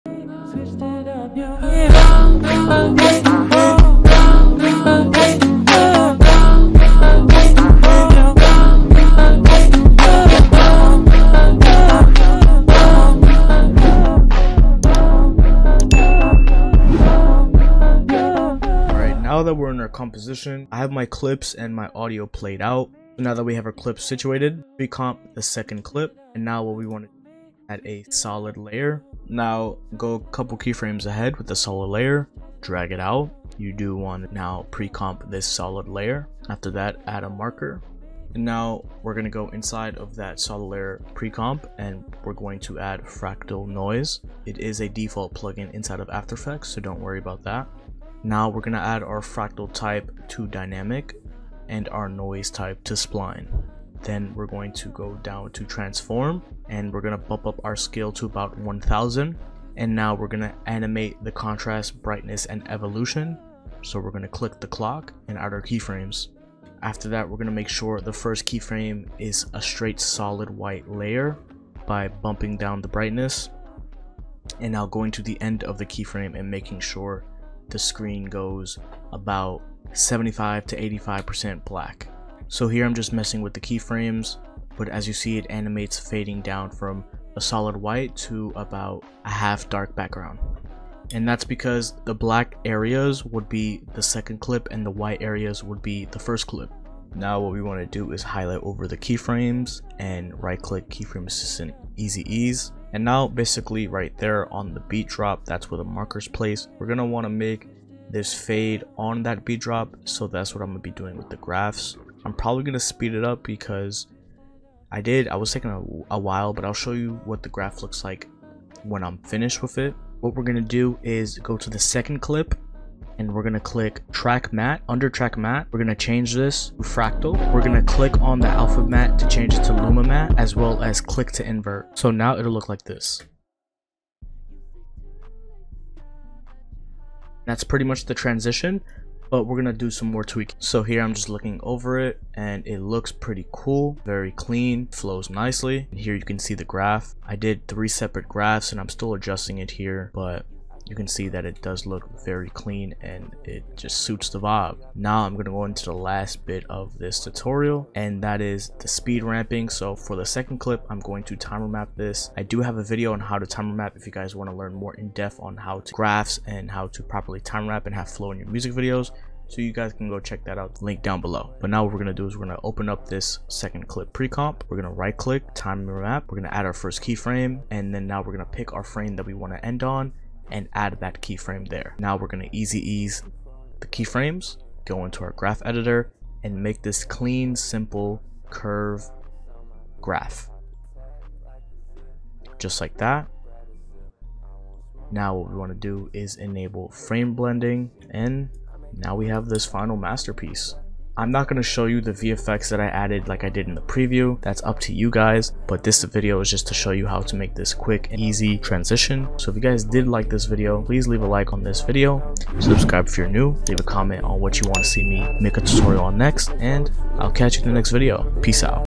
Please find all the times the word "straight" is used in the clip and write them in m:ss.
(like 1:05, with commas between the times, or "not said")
1:09.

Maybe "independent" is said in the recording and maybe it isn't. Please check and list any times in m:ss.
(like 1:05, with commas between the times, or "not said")
not said.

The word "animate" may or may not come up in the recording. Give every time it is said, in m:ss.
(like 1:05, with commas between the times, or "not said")
1:00, 1:25.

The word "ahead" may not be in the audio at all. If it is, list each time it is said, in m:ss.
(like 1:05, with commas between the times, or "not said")
0:31.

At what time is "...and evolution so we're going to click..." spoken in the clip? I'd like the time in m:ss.
1:02.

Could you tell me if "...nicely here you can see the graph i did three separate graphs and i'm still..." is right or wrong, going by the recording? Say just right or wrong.
right.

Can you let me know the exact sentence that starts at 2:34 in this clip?
Now I'm going to go into the last bit of this tutorial and that is the speed ramping.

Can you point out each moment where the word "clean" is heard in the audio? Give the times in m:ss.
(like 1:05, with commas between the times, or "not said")
2:24, 2:32, 3:07.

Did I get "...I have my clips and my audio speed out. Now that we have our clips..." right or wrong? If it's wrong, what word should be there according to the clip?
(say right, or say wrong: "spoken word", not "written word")
wrong: "played", not "speed".